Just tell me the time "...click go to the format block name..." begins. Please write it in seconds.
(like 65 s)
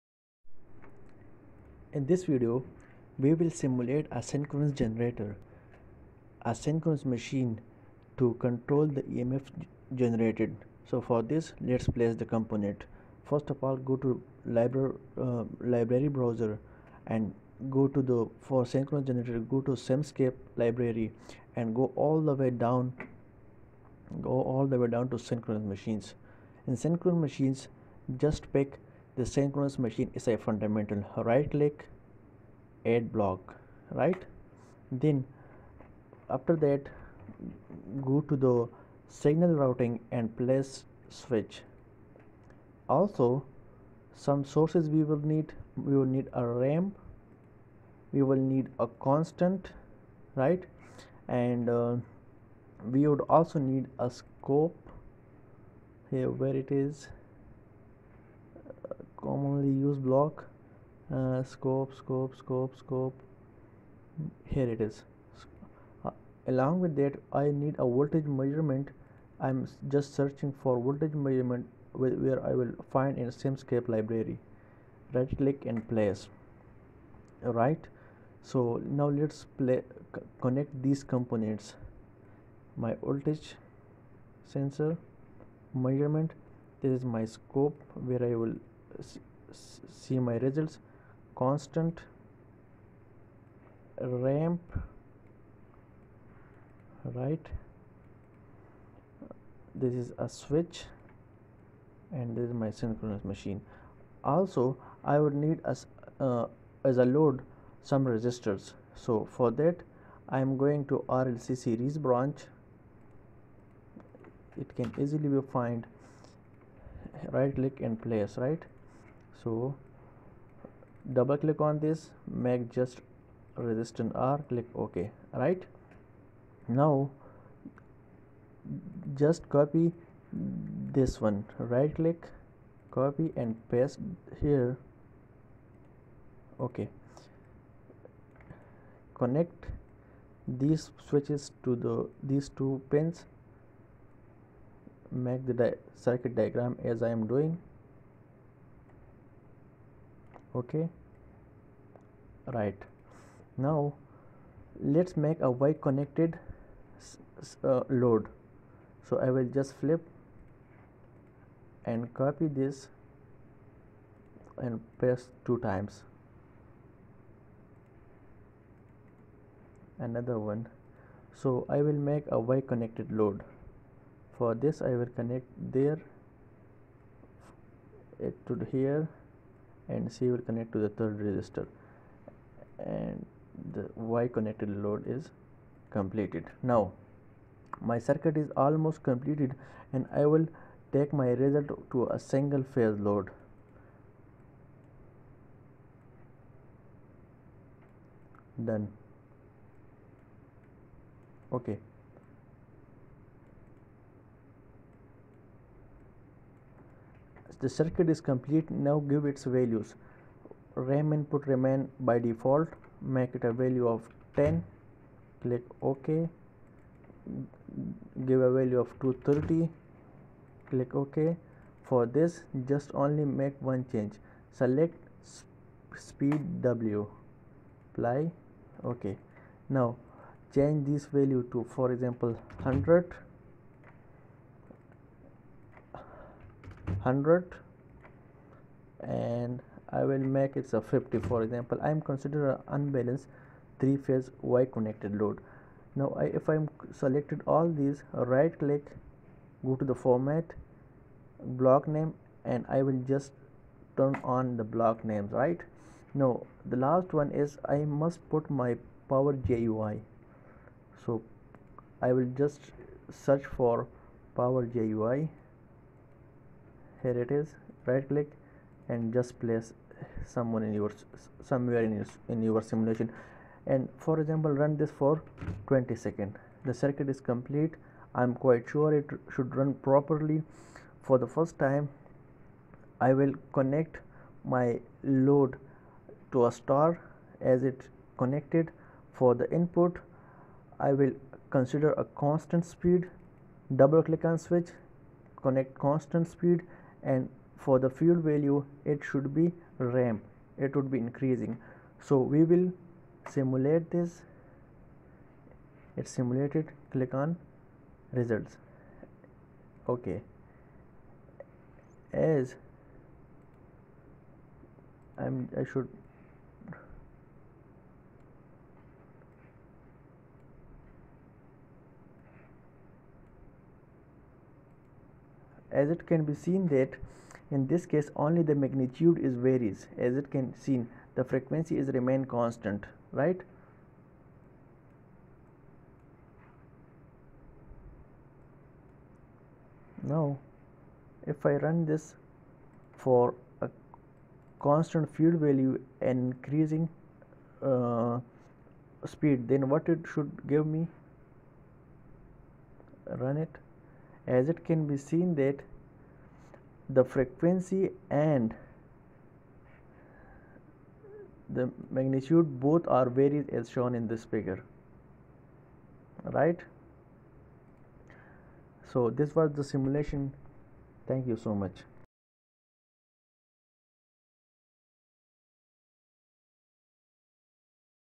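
248 s.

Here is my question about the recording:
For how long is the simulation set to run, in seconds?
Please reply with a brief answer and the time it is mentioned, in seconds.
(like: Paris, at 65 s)
20, at 275 s.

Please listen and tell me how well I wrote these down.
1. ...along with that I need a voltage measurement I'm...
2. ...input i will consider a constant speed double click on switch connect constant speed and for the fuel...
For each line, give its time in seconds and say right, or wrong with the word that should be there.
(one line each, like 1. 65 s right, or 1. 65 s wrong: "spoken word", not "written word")
1. 66 s right
2. 289 s right.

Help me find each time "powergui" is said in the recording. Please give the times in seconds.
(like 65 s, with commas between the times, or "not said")
259 s, 264 s.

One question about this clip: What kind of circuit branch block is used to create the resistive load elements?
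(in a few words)
RLC series branch.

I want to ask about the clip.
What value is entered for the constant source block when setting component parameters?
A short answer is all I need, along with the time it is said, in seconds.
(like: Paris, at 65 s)
230, at 219 s.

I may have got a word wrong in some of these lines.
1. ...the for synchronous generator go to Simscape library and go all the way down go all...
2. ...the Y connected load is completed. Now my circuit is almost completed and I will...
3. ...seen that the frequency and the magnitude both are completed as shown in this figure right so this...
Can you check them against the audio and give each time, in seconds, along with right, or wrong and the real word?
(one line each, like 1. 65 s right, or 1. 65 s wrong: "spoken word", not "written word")
1. 18 s right
2. 183 s right
3. 354 s wrong: "varied", not "completed".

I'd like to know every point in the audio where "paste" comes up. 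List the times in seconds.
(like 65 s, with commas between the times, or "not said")
133 s, 164 s.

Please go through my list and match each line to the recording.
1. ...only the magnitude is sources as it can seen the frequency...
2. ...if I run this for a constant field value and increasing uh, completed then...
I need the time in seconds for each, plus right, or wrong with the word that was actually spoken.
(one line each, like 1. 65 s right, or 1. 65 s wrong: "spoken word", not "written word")
1. 328 s wrong: "varies", not "sources"
2. 341 s wrong: "speed", not "completed".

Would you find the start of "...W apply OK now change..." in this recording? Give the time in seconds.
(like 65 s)
226 s.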